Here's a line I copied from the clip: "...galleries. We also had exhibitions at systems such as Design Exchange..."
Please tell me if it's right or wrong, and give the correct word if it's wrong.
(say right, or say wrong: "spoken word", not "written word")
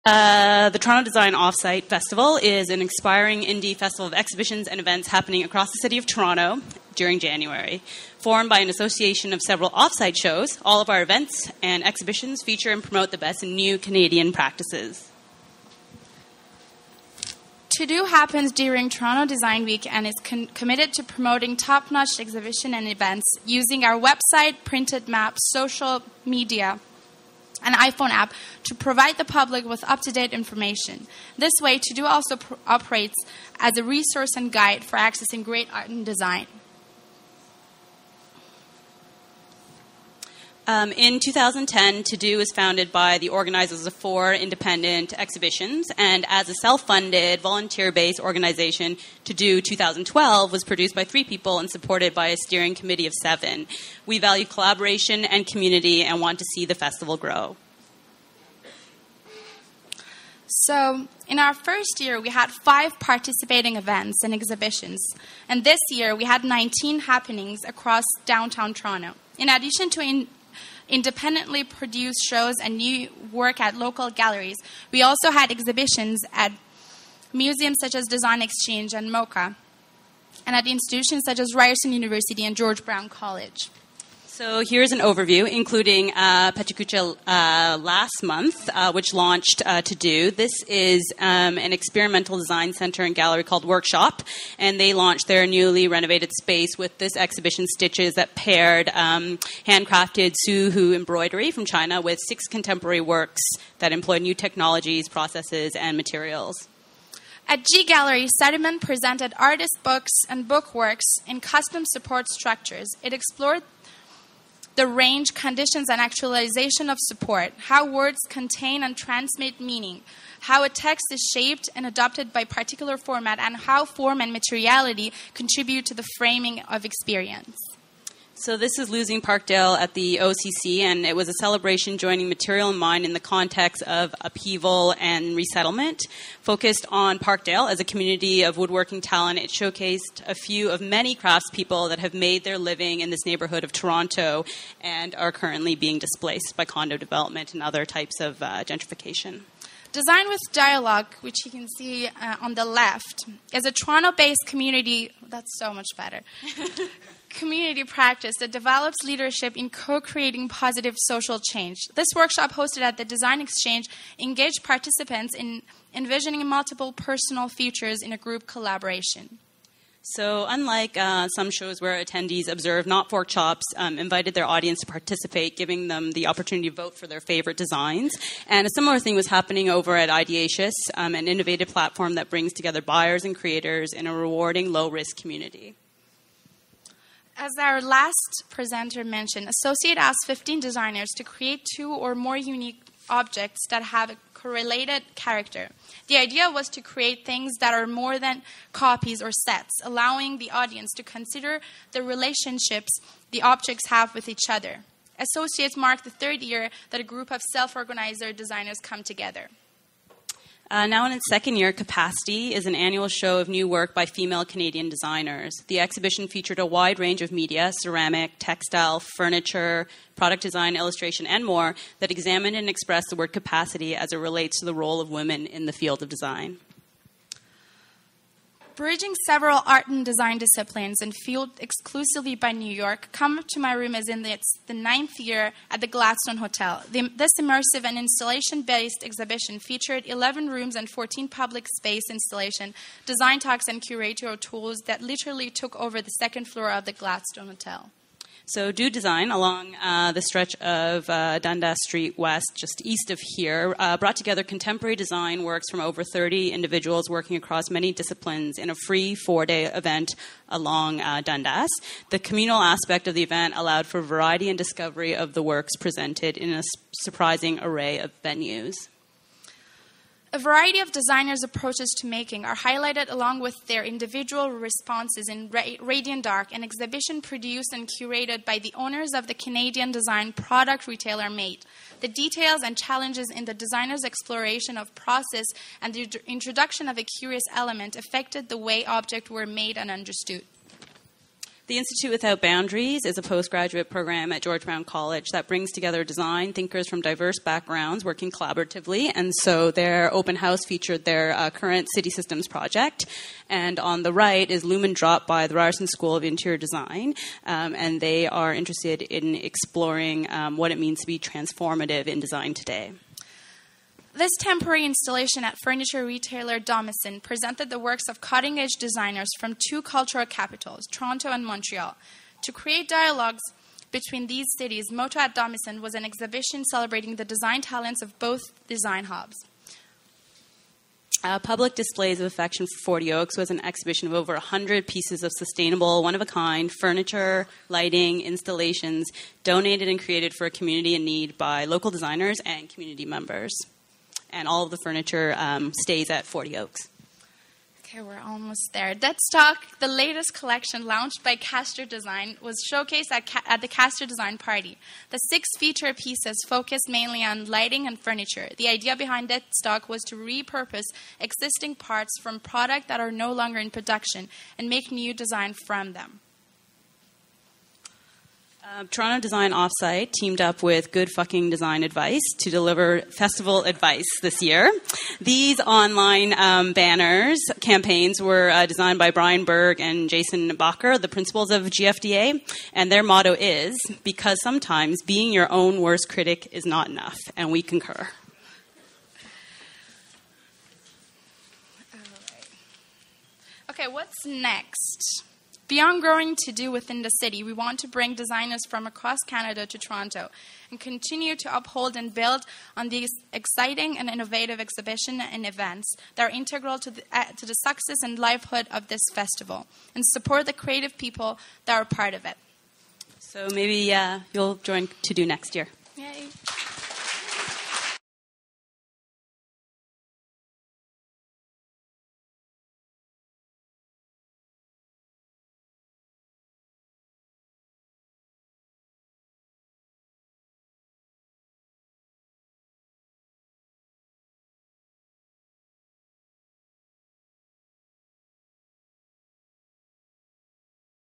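wrong: "museums", not "systems".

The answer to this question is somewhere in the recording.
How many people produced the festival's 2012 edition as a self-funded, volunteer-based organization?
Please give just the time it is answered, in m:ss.
0:51.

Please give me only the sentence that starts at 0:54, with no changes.
We value collaboration and community and want to see the festival grow.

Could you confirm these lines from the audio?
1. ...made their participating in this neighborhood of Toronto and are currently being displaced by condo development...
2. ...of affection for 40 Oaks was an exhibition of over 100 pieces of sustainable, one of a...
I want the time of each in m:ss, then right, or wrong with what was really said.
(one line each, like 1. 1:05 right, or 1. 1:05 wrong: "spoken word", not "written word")
1. 2:22 wrong: "living", not "participating"
2. 5:32 right.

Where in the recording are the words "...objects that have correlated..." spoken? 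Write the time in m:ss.
3:13.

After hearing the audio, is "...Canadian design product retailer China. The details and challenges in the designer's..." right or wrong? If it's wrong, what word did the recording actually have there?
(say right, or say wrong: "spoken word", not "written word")
wrong: "MADE", not "China".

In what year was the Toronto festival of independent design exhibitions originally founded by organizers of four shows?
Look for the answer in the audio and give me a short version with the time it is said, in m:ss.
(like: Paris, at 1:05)
2010, at 0:41.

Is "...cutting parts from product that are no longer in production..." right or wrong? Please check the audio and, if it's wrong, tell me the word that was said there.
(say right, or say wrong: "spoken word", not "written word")
wrong: "existing", not "cutting".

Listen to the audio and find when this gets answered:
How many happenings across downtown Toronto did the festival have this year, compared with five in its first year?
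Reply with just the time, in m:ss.
1:06.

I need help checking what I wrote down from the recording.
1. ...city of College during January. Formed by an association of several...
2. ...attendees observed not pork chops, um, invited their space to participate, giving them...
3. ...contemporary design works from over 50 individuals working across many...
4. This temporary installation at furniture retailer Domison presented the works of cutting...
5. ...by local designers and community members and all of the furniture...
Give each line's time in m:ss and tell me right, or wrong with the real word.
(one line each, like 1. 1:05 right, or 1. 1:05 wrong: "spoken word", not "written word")
1. 0:05 wrong: "Toronto", not "College"
2. 2:52 wrong: "audience", not "space"
3. 4:14 wrong: "30", not "50"
4. 5:14 right
5. 5:41 right.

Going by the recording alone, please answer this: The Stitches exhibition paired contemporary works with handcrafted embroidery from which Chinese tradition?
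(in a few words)
Suzhou.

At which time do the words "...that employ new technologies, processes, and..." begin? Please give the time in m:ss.
1:43.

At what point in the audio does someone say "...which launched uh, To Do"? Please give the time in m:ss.
1:28.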